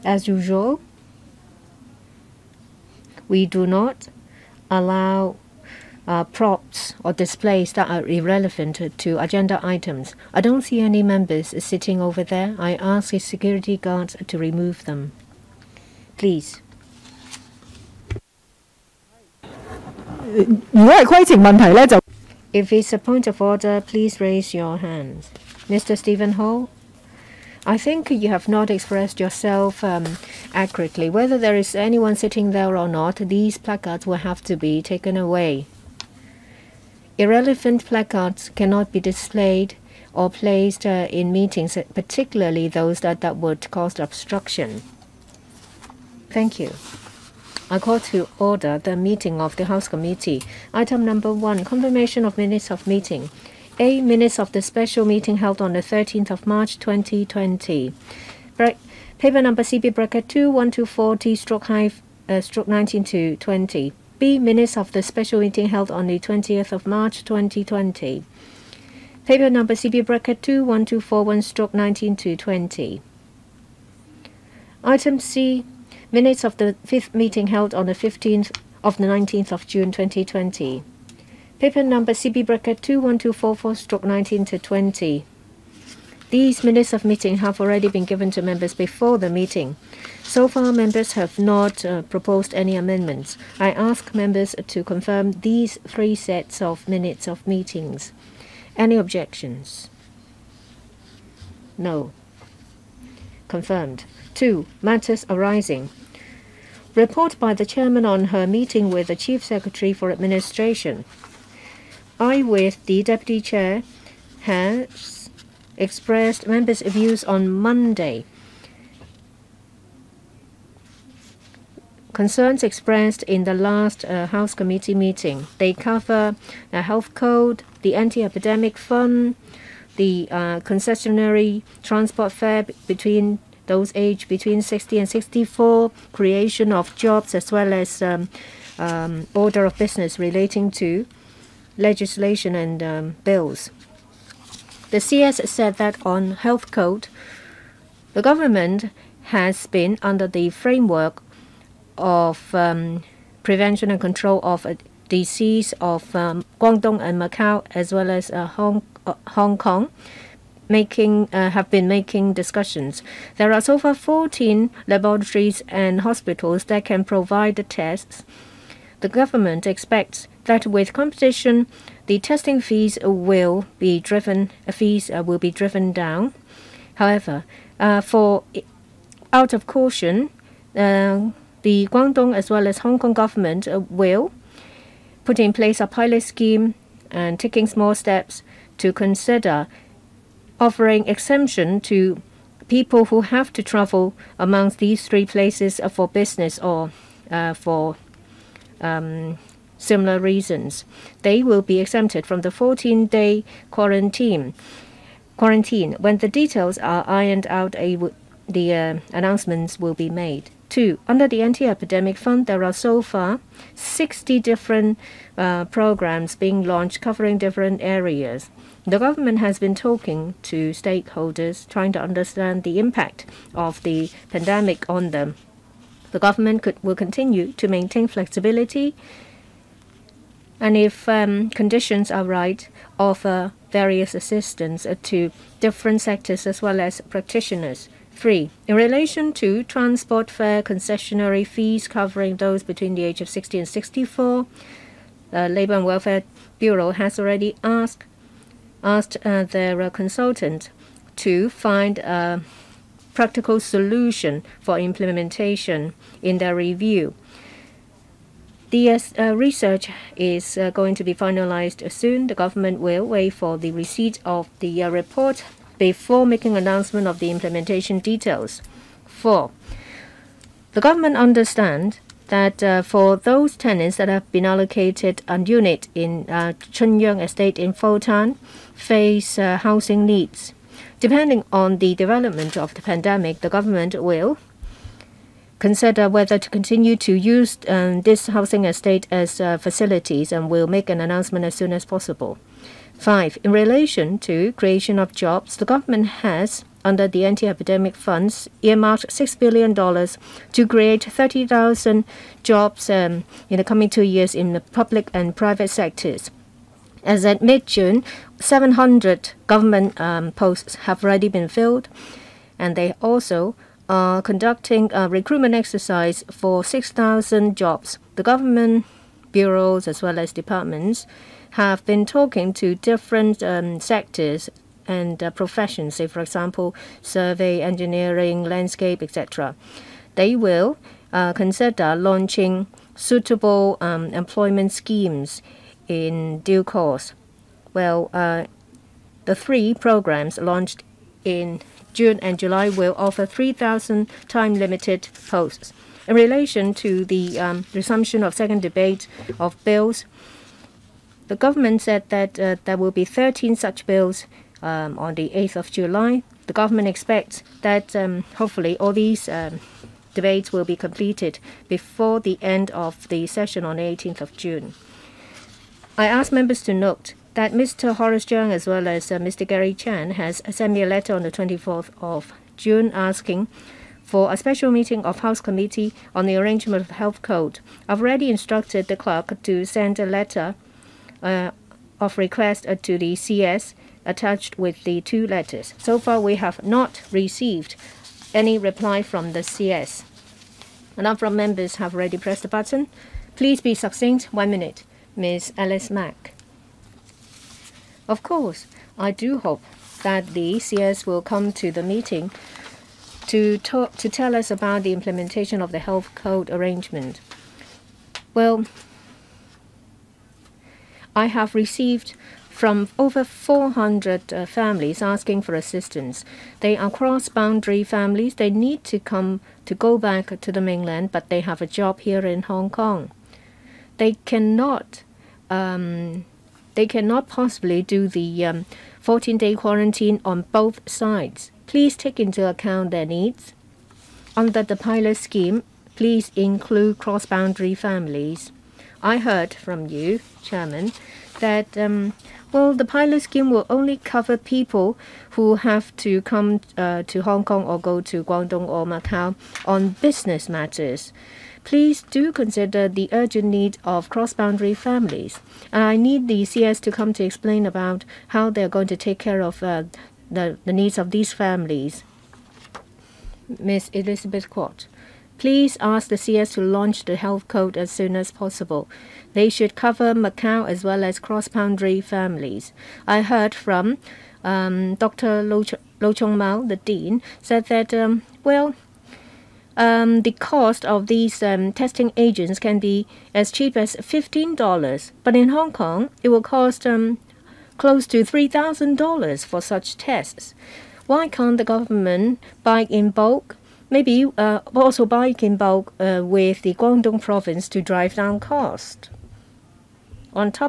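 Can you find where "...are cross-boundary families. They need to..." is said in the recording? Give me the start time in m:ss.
6:56.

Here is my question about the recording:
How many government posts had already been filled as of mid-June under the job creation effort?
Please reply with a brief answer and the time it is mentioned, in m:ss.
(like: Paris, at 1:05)
700, at 5:08.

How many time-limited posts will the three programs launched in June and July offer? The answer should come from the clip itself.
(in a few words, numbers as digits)
3,000.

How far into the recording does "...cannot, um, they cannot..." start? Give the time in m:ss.
7:04.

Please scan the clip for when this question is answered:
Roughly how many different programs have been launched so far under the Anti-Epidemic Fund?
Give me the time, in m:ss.
3:33.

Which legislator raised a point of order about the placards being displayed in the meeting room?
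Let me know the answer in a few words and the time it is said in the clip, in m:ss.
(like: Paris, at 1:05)
Stephen Hall, at 0:25.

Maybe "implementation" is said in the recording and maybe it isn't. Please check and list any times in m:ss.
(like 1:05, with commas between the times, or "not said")
4:14, 4:27, 6:44.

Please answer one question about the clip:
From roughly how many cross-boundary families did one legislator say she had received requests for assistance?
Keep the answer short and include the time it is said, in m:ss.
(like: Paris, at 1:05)
400, at 6:52.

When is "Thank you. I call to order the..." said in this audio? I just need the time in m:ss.
0:46.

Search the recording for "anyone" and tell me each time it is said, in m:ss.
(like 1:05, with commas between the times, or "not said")
0:31.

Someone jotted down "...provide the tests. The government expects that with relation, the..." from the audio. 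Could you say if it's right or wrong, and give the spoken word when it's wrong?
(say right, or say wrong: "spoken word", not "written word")
wrong: "competition", not "relation".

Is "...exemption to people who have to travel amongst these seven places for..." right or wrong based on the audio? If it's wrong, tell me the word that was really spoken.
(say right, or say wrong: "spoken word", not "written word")
wrong: "three", not "seven".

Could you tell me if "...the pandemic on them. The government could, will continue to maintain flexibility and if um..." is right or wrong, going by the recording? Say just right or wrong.
right.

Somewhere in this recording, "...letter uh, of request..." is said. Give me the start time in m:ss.
6:20.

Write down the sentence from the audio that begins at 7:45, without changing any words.
Please ask the CS to launch the health code as soon as possible.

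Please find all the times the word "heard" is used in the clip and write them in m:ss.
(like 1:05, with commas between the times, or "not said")
7:19, 7:53.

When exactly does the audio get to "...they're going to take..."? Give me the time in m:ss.
7:38.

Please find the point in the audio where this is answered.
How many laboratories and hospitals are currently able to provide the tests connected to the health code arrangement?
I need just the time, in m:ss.
2:43.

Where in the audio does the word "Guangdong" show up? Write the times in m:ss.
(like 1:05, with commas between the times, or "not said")
2:36, 3:01, 7:28, 8:16.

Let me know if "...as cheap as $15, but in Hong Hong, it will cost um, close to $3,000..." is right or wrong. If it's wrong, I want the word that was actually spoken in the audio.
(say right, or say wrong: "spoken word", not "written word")
wrong: "Kong", not "Hong".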